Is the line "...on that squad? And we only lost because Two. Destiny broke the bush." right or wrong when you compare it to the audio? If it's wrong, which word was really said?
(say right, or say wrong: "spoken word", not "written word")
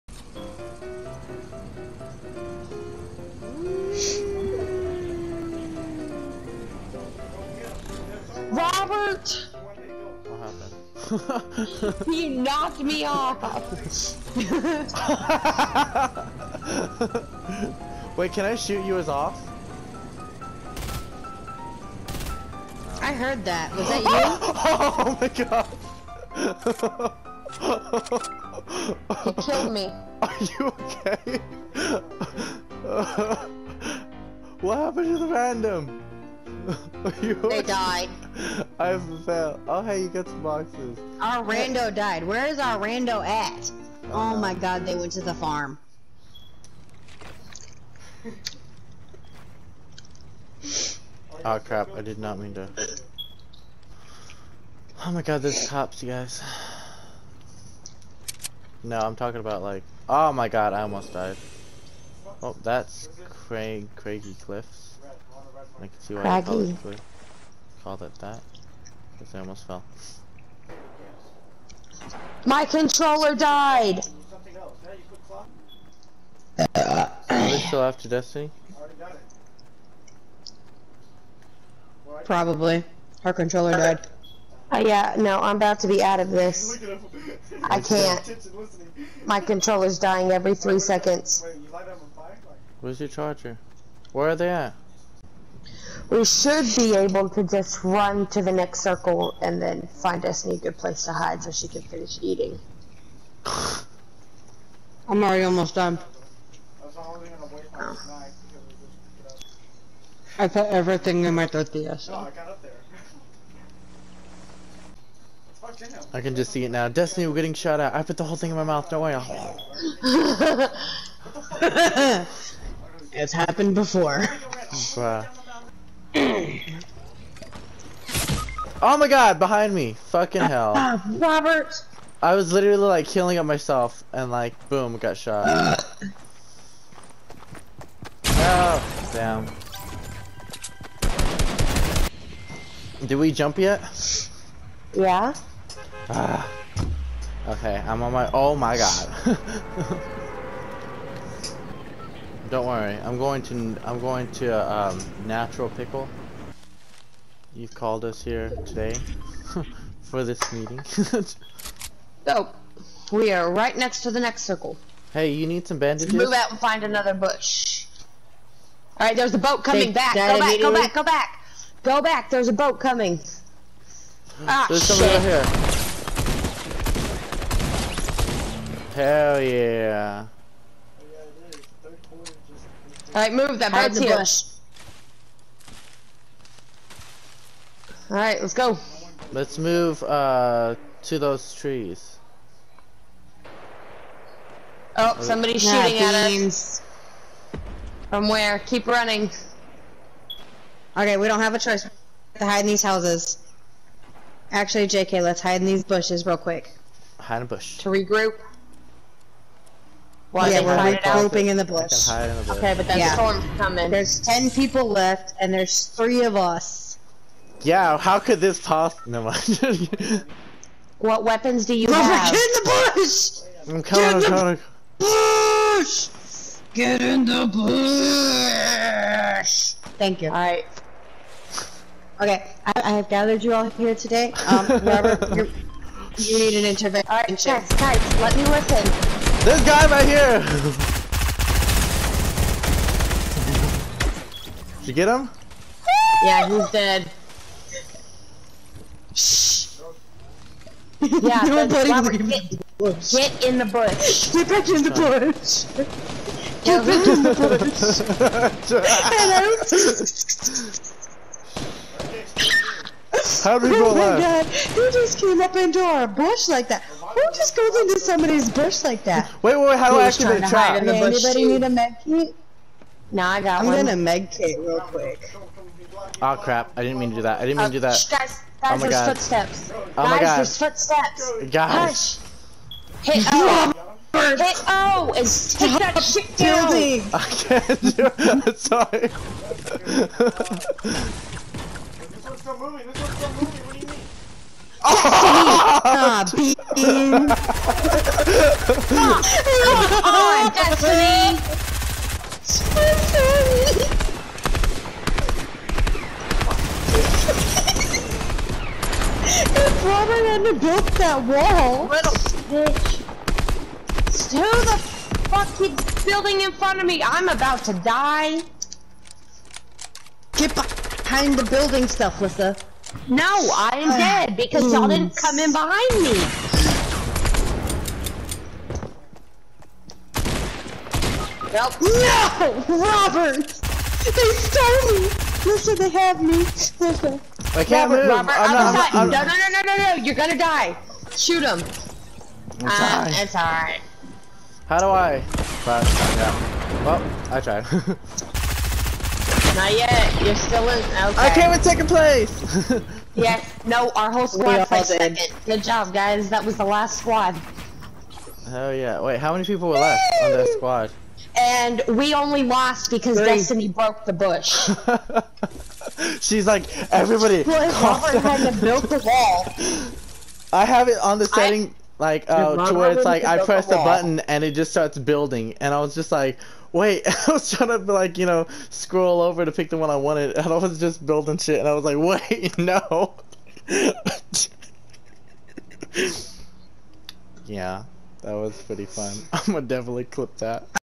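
wrong: "Three", not "Two".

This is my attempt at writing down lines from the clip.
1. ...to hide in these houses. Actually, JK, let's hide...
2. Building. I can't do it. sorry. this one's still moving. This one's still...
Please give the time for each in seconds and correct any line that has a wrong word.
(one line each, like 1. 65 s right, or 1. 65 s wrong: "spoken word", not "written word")
1. 202 s right
2. 286 s right.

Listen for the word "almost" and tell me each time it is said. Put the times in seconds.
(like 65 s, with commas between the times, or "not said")
60 s, 69 s, 105 s.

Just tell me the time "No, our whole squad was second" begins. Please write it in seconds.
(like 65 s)
353 s.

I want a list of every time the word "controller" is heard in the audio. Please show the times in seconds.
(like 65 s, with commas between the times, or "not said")
72 s, 83 s, 89 s.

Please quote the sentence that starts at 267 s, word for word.
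Who just goes into somebody's bush like that?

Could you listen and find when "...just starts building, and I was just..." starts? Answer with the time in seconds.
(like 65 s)
374 s.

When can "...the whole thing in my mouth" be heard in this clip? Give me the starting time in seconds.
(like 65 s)
118 s.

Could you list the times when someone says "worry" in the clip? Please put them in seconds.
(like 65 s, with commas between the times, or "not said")
119 s, 152 s.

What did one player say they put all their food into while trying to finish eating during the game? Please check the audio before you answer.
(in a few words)
tortilla.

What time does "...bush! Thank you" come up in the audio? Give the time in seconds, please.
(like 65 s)
227 s.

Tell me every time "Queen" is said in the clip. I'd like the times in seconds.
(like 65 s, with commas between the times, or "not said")
296 s.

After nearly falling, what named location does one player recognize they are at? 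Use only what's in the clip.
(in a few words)
Craggy Cliffs.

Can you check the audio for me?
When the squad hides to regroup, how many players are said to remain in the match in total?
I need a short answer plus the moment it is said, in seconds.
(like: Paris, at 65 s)
10, at 214 s.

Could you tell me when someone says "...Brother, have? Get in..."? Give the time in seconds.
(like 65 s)
221 s.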